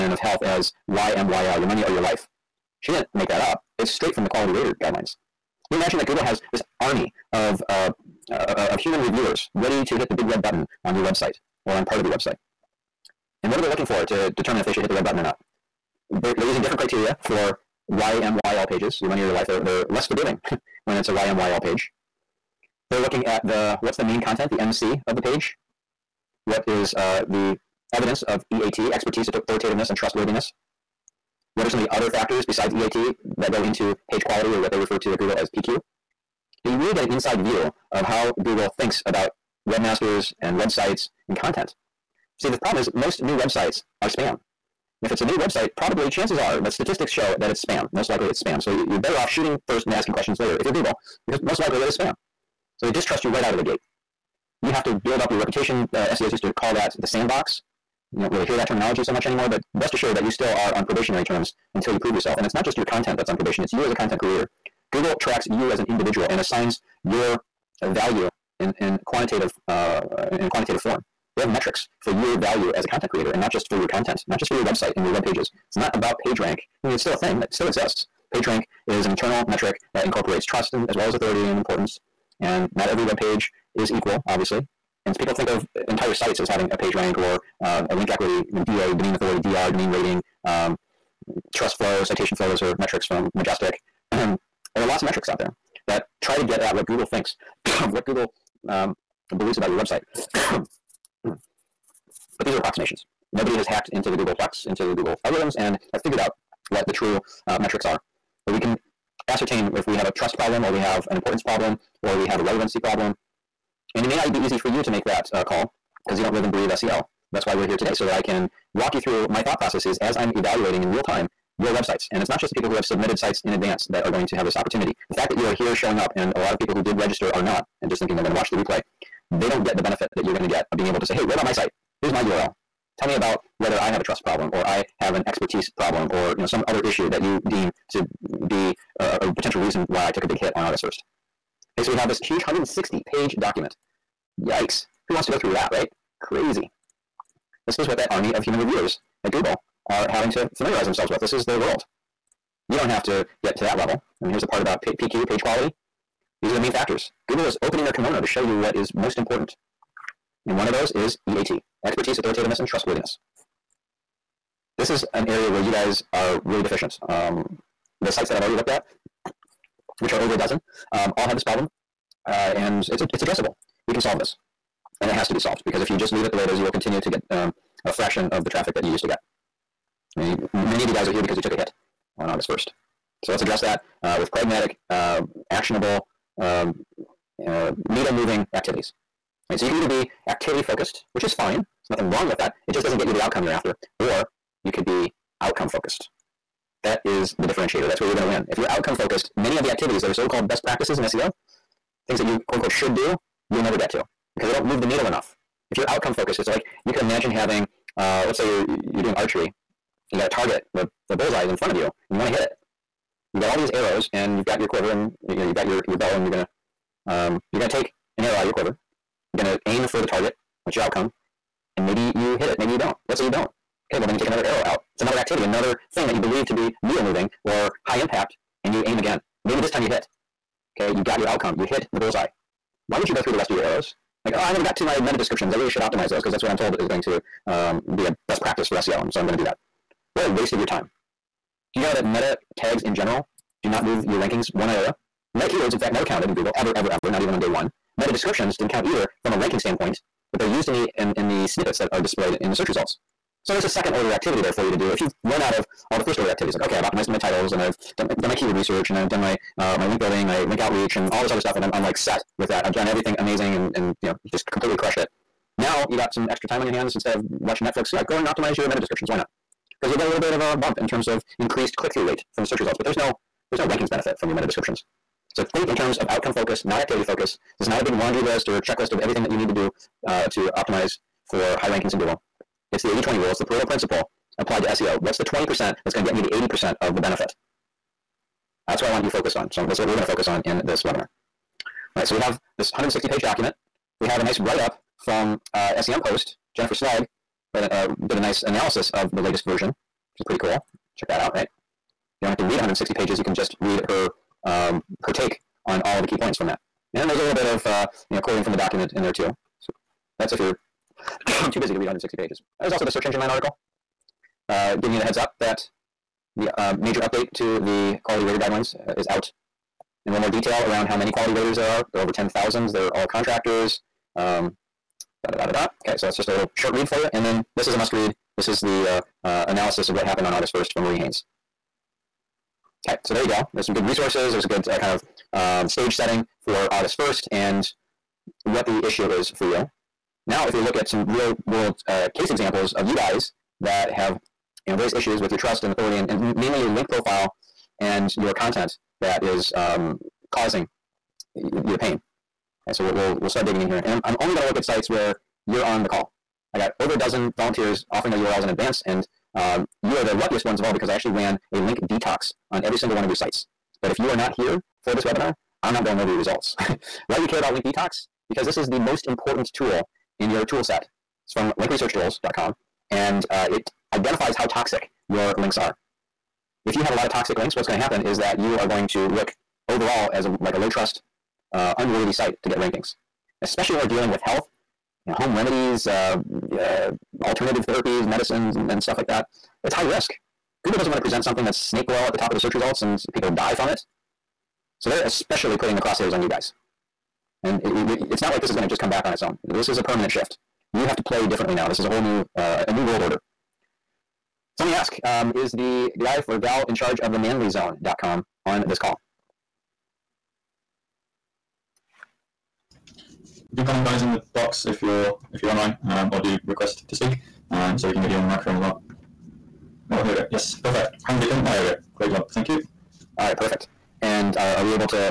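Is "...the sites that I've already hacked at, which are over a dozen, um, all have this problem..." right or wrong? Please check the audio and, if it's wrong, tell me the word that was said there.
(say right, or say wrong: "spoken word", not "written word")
wrong: "looked", not "hacked".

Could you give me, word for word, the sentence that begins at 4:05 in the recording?
Meta keywords, in fact, never counted in Google, ever, ever, ever, not even on day one.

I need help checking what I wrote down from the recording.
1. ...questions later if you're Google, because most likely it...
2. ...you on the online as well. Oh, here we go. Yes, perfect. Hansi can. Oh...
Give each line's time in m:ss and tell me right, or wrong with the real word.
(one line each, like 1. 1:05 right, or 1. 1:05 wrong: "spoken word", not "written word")
1. 0:50 right
2. 6:58 wrong: "microphone", not "online".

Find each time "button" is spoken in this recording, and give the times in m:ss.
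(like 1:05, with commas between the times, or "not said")
0:10, 0:15.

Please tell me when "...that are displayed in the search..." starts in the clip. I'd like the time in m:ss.
4:11.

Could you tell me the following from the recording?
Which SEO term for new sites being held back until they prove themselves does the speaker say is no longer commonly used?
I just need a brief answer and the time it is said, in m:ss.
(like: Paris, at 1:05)
the sandbox, at 0:56.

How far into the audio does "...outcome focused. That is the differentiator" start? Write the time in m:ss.
3:15.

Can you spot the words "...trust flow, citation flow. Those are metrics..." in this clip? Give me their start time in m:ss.
1:31.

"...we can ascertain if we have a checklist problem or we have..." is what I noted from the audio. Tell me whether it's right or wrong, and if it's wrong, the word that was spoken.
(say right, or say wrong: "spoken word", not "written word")
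wrong: "trust", not "checklist".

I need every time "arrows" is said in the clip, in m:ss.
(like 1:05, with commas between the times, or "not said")
3:33, 3:38, 3:44, 3:53.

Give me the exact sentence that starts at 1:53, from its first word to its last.
And it may not be easy for you to make that uh, call because you don't live and breathe SEO.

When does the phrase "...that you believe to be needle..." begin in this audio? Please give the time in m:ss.
3:46.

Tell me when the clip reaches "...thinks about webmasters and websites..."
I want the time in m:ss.
0:38.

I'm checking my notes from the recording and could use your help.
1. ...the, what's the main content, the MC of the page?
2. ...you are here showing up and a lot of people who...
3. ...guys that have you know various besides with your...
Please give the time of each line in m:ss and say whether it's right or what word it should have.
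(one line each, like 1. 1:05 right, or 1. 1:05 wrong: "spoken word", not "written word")
1. 0:23 right
2. 2:05 right
3. 5:42 wrong: "issues", not "besides".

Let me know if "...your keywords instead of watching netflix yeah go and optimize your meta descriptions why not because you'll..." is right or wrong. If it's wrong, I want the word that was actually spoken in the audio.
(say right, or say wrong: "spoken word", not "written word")
wrong: "hands", not "keywords".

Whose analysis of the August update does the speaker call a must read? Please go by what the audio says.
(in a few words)
Marie Haynes.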